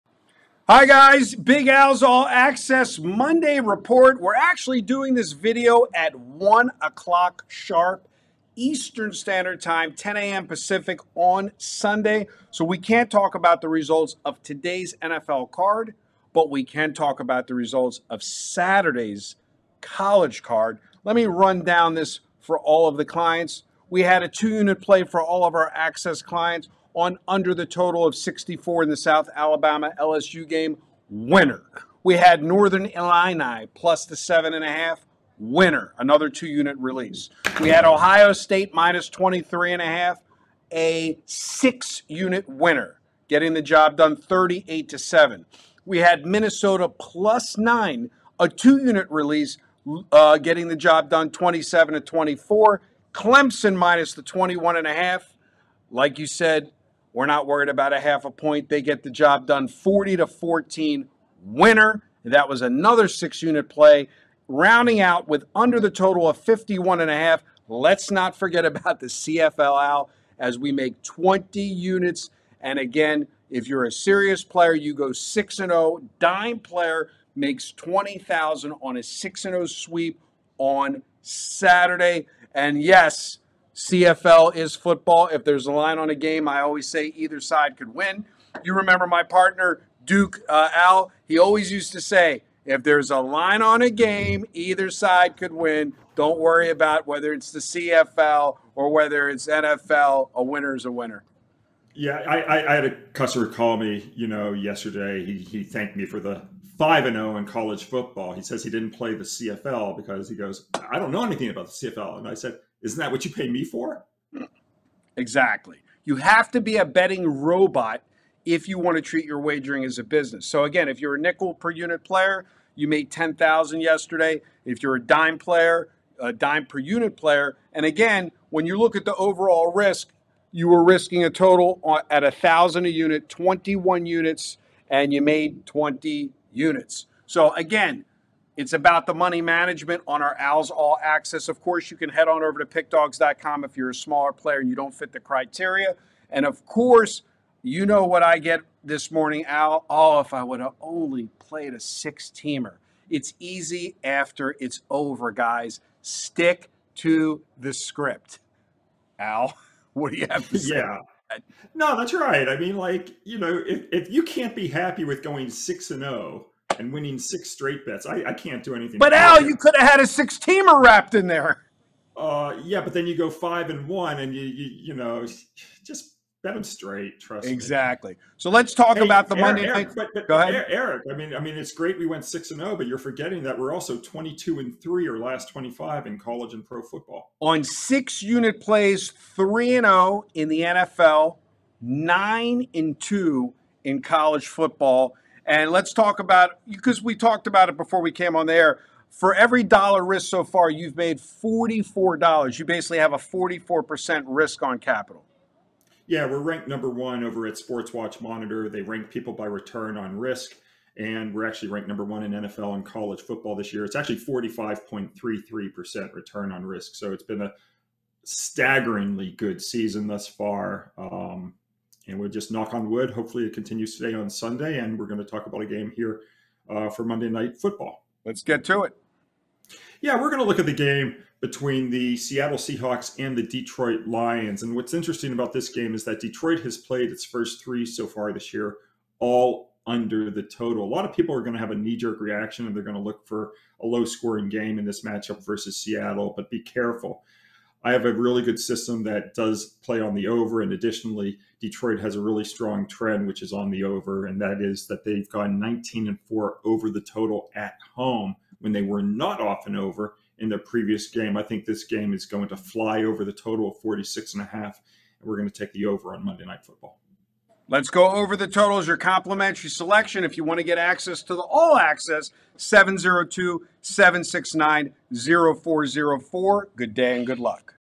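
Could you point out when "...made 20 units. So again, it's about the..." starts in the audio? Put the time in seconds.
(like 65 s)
135 s.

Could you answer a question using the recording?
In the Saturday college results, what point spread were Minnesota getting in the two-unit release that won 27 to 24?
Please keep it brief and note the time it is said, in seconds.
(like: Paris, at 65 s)
+9, at 46 s.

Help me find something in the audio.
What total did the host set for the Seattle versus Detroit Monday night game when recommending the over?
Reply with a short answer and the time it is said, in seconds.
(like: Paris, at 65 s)
46.5, at 263 s.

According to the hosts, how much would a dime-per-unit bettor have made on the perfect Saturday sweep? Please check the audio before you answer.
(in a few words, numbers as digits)
20,000.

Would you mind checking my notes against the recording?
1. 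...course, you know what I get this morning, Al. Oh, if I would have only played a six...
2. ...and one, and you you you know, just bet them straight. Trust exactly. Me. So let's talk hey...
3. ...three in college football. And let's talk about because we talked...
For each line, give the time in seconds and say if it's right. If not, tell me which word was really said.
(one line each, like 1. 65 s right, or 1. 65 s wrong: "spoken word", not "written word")
1. 146 s right
2. 173 s right
3. 192 s wrong: "two", not "three".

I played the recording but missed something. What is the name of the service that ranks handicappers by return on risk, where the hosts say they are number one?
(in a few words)
Sports Watch Monitor.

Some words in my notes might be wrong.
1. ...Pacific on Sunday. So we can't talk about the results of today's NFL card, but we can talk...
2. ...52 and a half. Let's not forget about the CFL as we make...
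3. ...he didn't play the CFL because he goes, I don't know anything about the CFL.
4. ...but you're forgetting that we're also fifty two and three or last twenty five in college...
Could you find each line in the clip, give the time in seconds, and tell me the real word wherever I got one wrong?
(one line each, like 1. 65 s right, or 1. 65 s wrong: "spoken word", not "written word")
1. 10 s right
2. 66 s wrong: "51", not "52"
3. 108 s right
4. 182 s wrong: "twenty", not "fifty".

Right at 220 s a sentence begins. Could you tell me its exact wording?
Um, and we'll just knock on wood.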